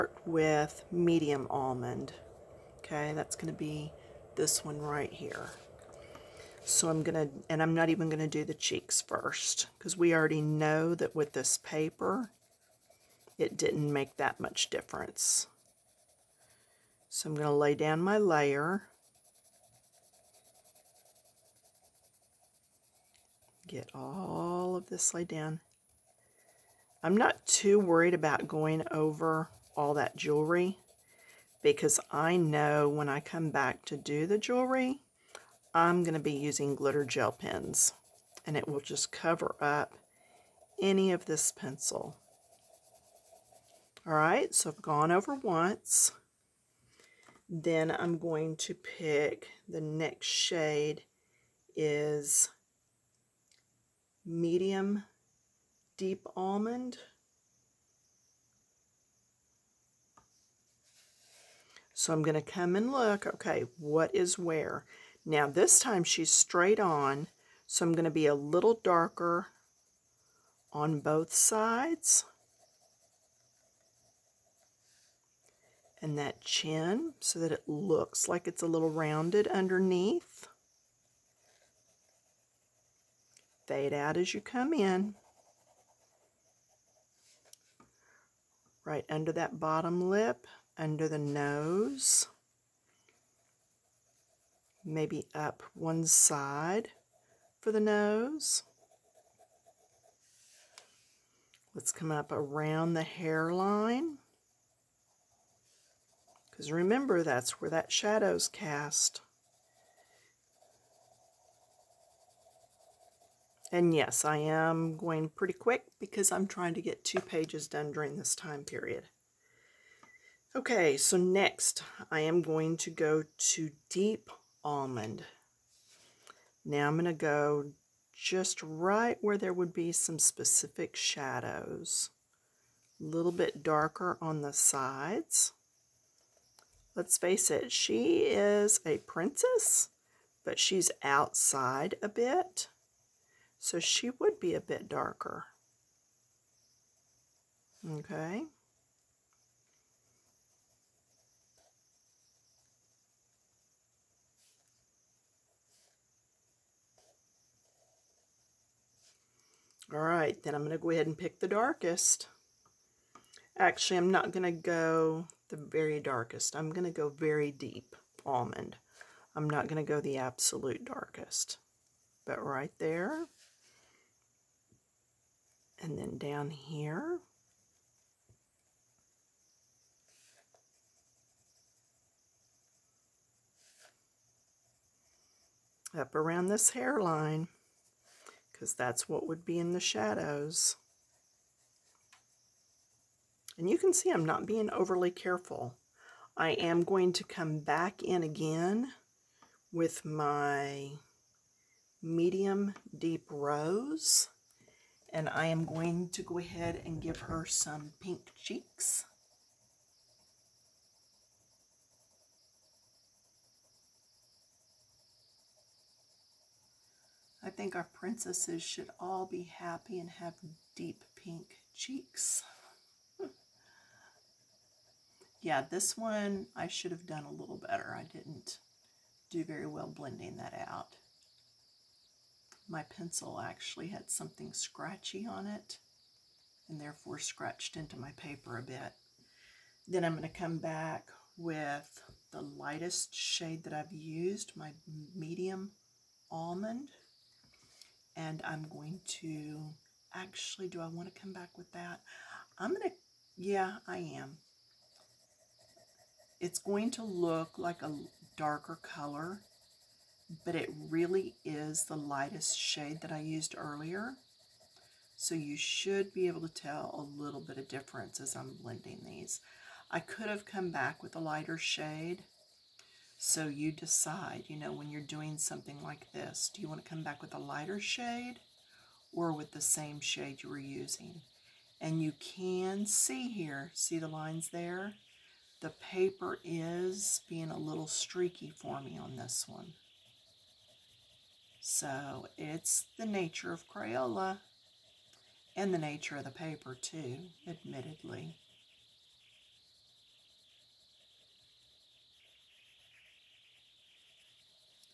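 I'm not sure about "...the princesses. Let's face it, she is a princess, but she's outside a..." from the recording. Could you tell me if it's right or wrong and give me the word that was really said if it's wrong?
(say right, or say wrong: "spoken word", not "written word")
wrong: "sides", not "princesses".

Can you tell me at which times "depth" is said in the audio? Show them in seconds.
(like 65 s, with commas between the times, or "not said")
not said.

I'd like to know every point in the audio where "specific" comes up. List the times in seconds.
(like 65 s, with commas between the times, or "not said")
130 s.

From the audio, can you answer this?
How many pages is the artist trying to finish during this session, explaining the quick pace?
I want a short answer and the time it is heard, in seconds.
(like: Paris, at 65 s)
2, at 117 s.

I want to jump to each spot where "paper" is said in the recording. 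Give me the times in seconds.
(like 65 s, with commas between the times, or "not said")
11 s, 238 s, 285 s, 296 s.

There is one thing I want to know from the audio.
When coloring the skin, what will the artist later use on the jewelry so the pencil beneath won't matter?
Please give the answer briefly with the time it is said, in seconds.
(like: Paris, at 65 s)
glitter gel pens, at 36 s.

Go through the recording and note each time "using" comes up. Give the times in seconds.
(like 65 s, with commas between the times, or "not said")
36 s, 280 s.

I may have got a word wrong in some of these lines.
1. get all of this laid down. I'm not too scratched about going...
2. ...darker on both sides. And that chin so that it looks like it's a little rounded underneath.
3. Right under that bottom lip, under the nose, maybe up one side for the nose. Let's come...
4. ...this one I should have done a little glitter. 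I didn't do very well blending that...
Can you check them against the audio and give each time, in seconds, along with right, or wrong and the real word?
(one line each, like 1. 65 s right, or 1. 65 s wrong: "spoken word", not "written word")
1. 23 s wrong: "worried", not "scratched"
2. 68 s right
3. 88 s right
4. 225 s wrong: "better", not "glitter".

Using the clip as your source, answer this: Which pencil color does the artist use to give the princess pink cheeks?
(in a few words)
medium deep rose.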